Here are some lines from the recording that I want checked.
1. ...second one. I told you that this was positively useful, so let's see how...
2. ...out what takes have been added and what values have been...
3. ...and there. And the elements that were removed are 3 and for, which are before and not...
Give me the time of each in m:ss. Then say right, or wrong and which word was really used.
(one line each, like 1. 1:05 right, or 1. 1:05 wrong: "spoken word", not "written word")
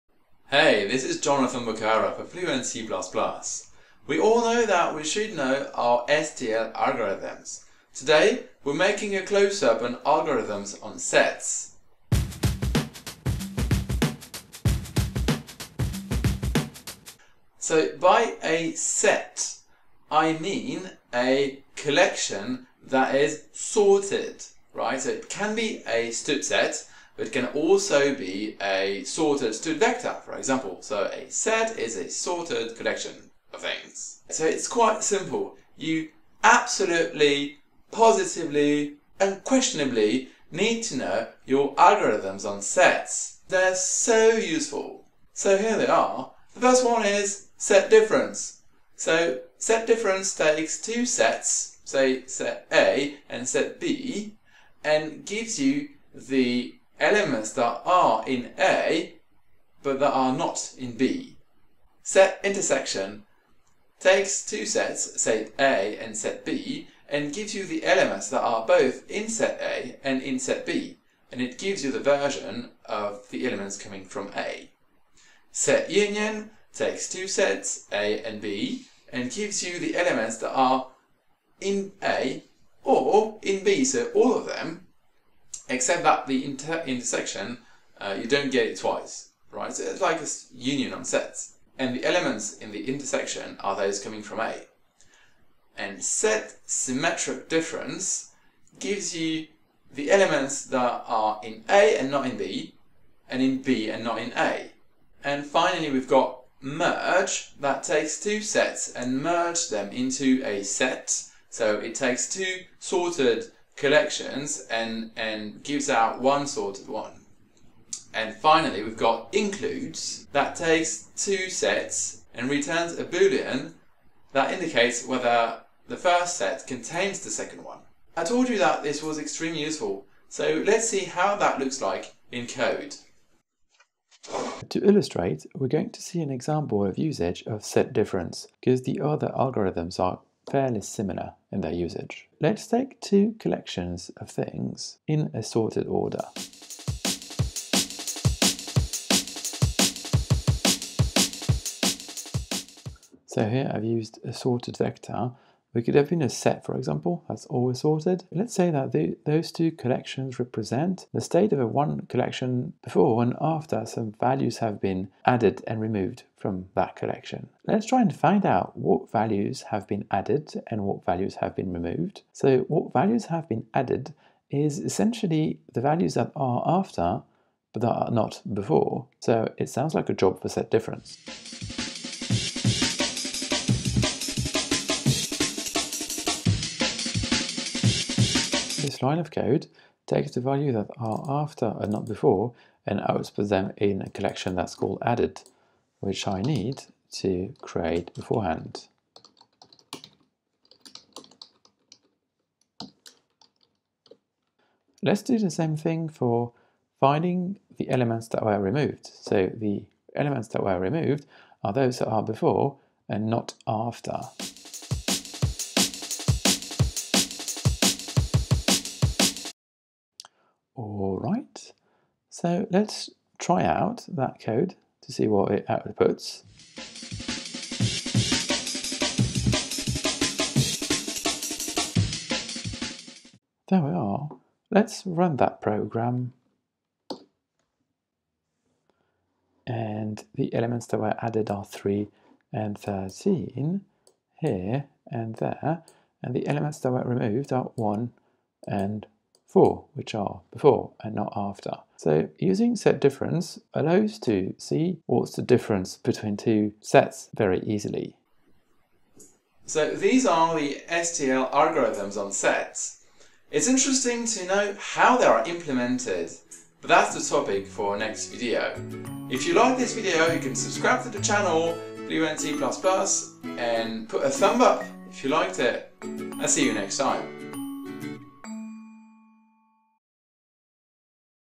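1. 2:07 wrong: "extremely", not "positively"
2. 2:48 wrong: "values", not "takes"
3. 4:05 wrong: "1", not "3".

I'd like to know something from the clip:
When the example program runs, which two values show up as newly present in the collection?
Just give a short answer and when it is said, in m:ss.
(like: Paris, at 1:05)
3 and 13, at 4:01.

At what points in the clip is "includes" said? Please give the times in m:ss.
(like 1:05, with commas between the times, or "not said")
1:59.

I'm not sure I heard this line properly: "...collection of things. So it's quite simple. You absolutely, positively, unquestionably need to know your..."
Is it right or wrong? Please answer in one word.
right.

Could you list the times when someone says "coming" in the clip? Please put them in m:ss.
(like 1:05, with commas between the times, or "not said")
1:13, 1:34.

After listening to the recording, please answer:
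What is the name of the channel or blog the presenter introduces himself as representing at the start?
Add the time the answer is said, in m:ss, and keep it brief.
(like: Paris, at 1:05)
Fluent C++, at 0:02.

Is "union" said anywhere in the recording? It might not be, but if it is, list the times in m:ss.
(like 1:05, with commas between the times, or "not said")
1:15, 1:30.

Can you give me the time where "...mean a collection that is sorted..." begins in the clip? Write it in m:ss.
0:20.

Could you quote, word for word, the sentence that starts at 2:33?
So here I've used a sorted vector we could have been a set, for example, that's always sorted.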